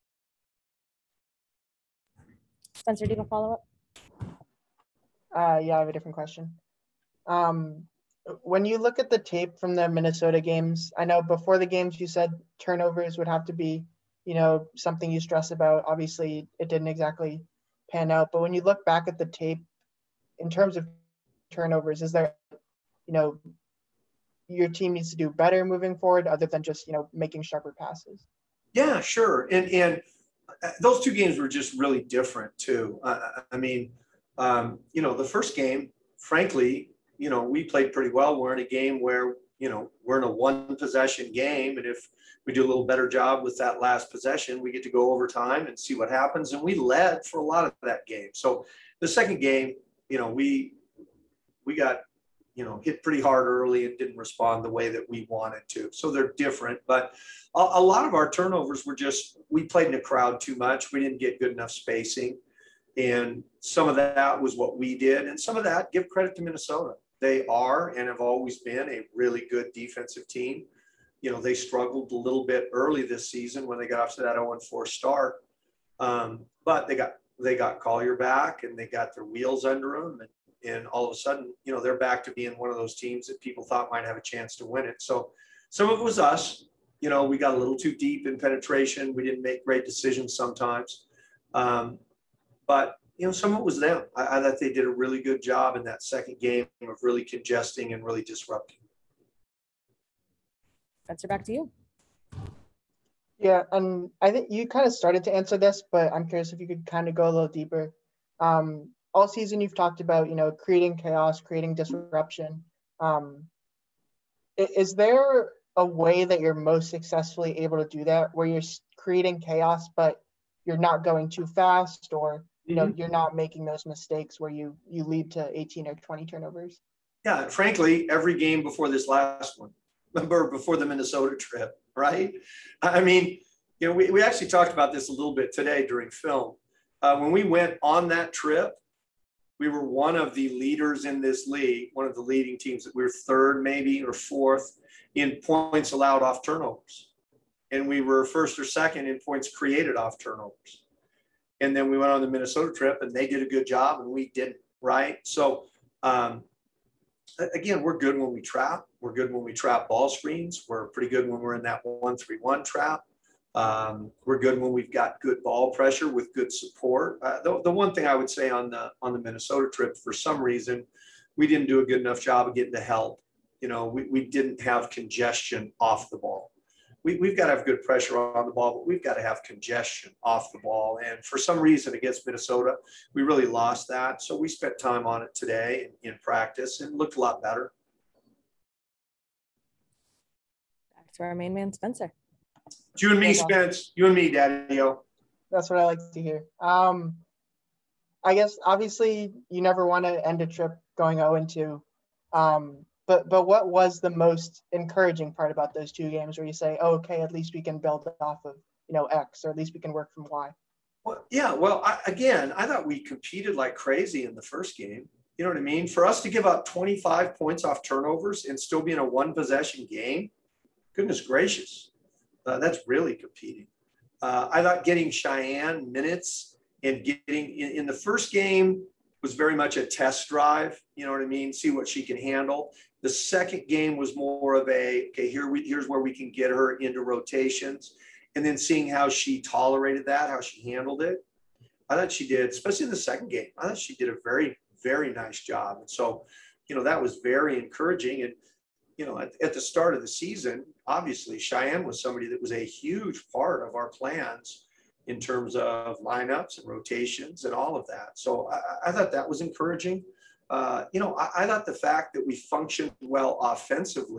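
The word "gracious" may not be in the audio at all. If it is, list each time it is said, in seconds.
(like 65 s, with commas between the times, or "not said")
221 s.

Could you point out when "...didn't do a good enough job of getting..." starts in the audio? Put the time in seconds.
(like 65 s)
171 s.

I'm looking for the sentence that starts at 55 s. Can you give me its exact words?
So they're different, but a, a lot of our turnovers were just, we played in a crowd too much.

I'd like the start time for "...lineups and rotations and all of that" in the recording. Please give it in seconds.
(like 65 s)
255 s.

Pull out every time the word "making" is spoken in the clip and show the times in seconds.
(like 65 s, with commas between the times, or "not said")
27 s, 123 s.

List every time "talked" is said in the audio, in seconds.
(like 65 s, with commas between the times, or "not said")
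109 s, 134 s.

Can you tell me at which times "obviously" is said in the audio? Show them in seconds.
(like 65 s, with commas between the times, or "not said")
15 s, 198 s, 250 s.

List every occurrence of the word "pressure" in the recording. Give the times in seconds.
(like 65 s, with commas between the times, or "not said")
165 s, 177 s.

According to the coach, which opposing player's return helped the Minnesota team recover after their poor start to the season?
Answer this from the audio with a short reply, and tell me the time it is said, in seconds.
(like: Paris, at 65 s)
Collier, at 77 s.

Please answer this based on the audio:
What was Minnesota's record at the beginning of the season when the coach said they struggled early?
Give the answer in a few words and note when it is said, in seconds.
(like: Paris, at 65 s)
0-4, at 74 s.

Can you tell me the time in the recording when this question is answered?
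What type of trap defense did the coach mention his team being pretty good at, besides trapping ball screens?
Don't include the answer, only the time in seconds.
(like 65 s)
161 s.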